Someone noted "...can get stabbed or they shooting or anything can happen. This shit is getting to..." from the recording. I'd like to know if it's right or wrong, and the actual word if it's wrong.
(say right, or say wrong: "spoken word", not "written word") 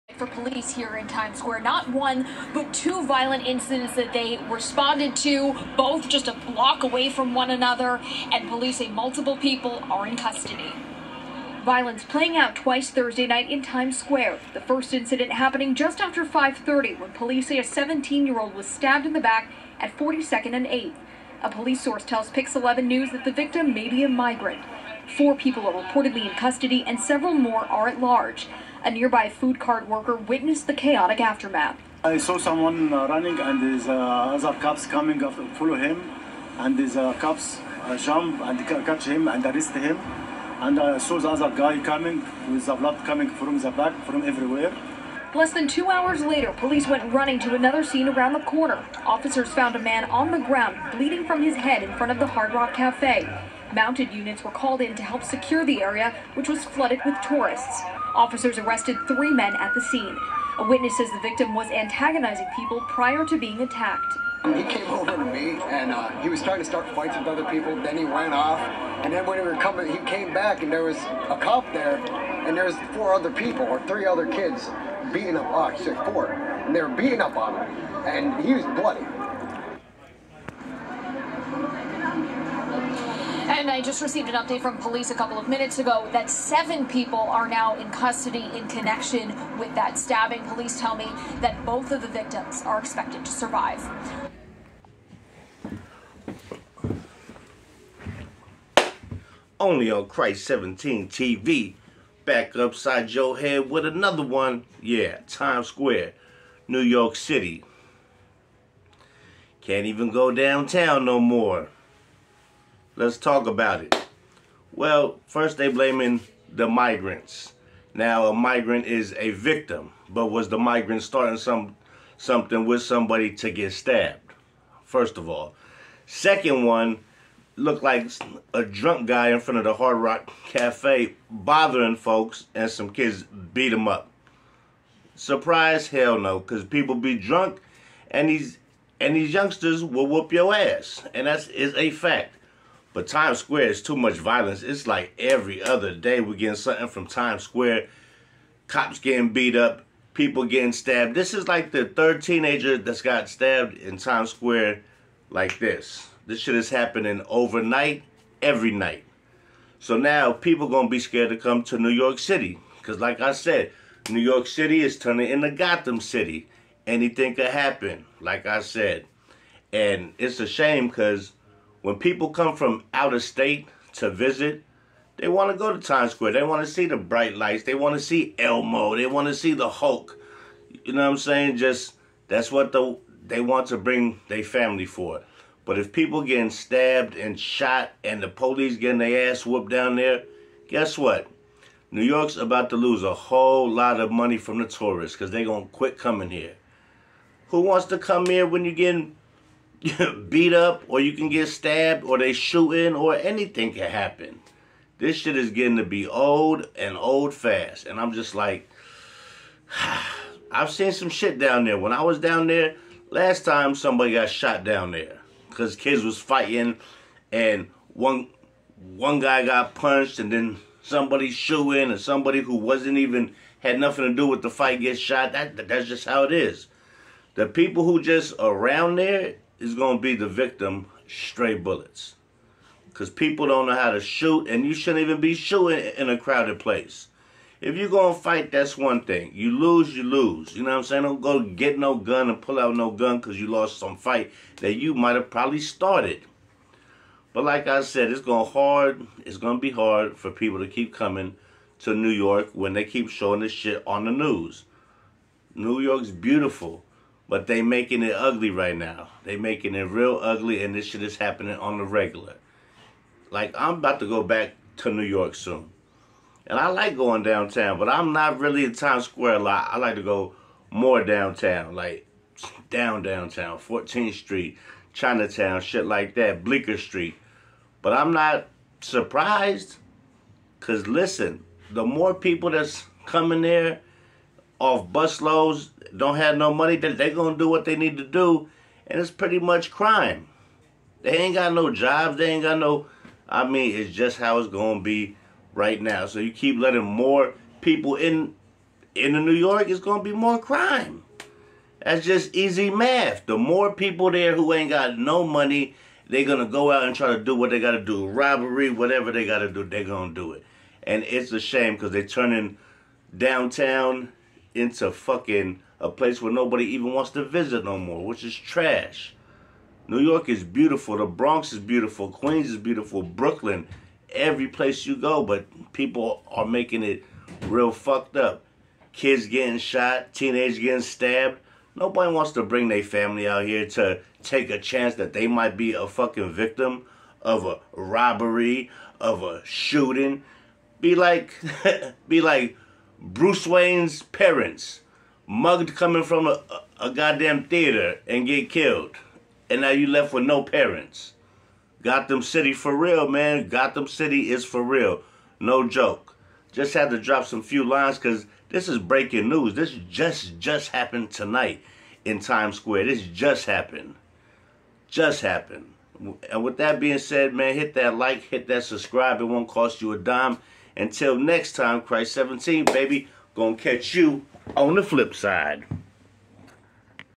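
right.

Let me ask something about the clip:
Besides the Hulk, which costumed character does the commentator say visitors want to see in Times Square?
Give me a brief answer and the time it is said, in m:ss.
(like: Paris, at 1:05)
Elmo, at 2:58.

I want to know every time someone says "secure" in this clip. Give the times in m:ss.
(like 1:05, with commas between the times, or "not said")
0:55.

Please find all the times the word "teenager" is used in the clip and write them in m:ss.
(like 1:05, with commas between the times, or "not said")
2:32, 5:30.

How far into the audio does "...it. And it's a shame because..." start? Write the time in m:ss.
5:10.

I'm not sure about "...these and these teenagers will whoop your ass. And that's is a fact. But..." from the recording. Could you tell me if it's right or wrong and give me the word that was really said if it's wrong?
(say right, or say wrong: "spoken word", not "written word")
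wrong: "youngsters", not "teenagers".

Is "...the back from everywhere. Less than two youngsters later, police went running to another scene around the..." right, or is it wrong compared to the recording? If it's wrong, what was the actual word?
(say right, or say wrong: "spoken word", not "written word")
wrong: "hours", not "youngsters".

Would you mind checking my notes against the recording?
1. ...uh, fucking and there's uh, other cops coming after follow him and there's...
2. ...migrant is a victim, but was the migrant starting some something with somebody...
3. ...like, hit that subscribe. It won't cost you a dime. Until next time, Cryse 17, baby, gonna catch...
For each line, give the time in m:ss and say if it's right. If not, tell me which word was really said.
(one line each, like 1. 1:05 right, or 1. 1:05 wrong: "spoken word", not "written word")
1. 0:32 wrong: "running", not "fucking"
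2. 1:58 right
3. 6:07 right.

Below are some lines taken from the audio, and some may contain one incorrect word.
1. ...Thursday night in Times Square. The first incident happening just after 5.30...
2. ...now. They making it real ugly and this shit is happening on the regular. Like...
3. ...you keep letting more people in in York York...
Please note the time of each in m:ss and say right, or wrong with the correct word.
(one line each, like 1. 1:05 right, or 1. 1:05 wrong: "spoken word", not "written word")
1. 0:12 right
2. 4:18 right
3. 4:56 wrong: "New", not "York".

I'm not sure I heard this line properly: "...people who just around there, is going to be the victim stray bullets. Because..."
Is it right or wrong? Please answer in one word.
right.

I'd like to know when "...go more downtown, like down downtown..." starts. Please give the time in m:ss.
4:30.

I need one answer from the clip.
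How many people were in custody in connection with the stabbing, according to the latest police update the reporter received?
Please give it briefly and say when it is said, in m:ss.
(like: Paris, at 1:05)
7, at 1:26.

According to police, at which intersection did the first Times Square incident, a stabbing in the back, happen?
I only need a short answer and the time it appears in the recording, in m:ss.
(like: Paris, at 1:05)
42nd and 8th, at 0:19.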